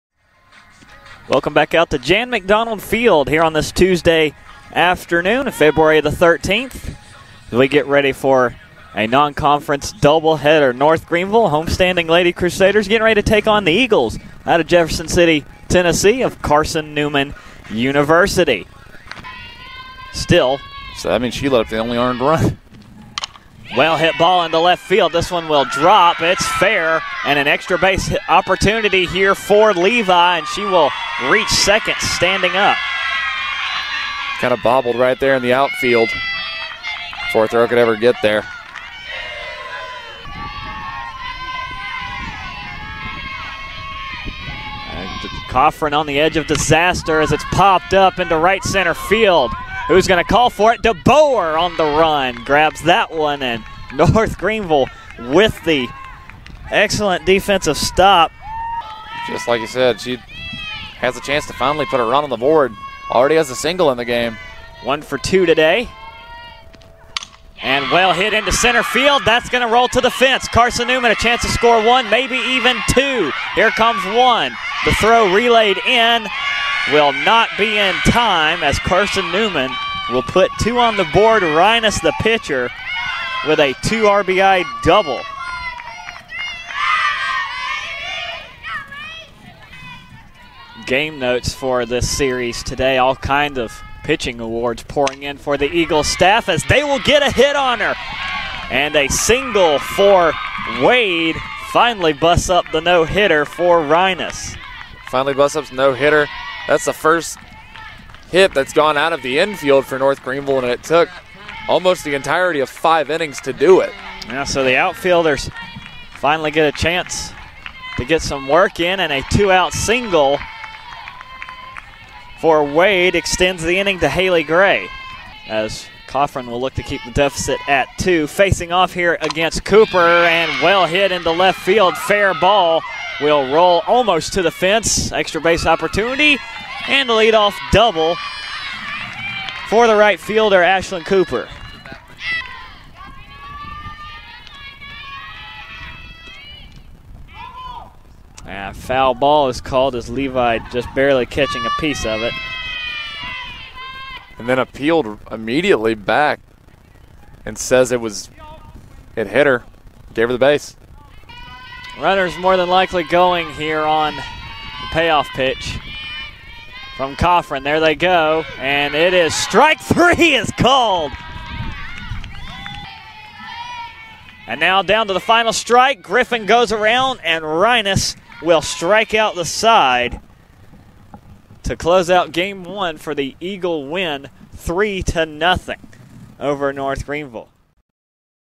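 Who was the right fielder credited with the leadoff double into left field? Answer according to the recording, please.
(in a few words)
Ashlyn Cooper.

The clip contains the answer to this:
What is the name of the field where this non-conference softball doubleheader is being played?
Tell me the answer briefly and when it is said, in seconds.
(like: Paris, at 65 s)
Jan McDonald Field, at 1 s.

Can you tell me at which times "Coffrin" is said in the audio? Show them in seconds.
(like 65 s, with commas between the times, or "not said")
45 s, 126 s, 167 s.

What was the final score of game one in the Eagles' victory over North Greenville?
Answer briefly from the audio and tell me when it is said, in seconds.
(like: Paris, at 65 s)
3-0, at 184 s.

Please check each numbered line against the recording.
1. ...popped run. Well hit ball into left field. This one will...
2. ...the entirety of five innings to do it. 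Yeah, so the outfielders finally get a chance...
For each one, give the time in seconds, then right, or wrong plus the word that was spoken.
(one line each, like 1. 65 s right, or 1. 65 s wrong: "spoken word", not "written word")
1. 21 s wrong: "earned", not "popped"
2. 112 s right.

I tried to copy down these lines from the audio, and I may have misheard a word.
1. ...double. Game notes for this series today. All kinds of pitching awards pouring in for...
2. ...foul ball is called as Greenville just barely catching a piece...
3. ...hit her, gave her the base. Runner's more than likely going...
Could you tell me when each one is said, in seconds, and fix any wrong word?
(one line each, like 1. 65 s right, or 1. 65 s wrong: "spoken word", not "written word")
1. 84 s right
2. 148 s wrong: "Levi", not "Greenville"
3. 159 s right.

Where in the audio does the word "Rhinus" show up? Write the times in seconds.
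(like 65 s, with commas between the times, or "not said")
81 s, 103 s, 177 s.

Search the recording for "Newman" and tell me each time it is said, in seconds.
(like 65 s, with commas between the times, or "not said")
16 s, 70 s, 79 s.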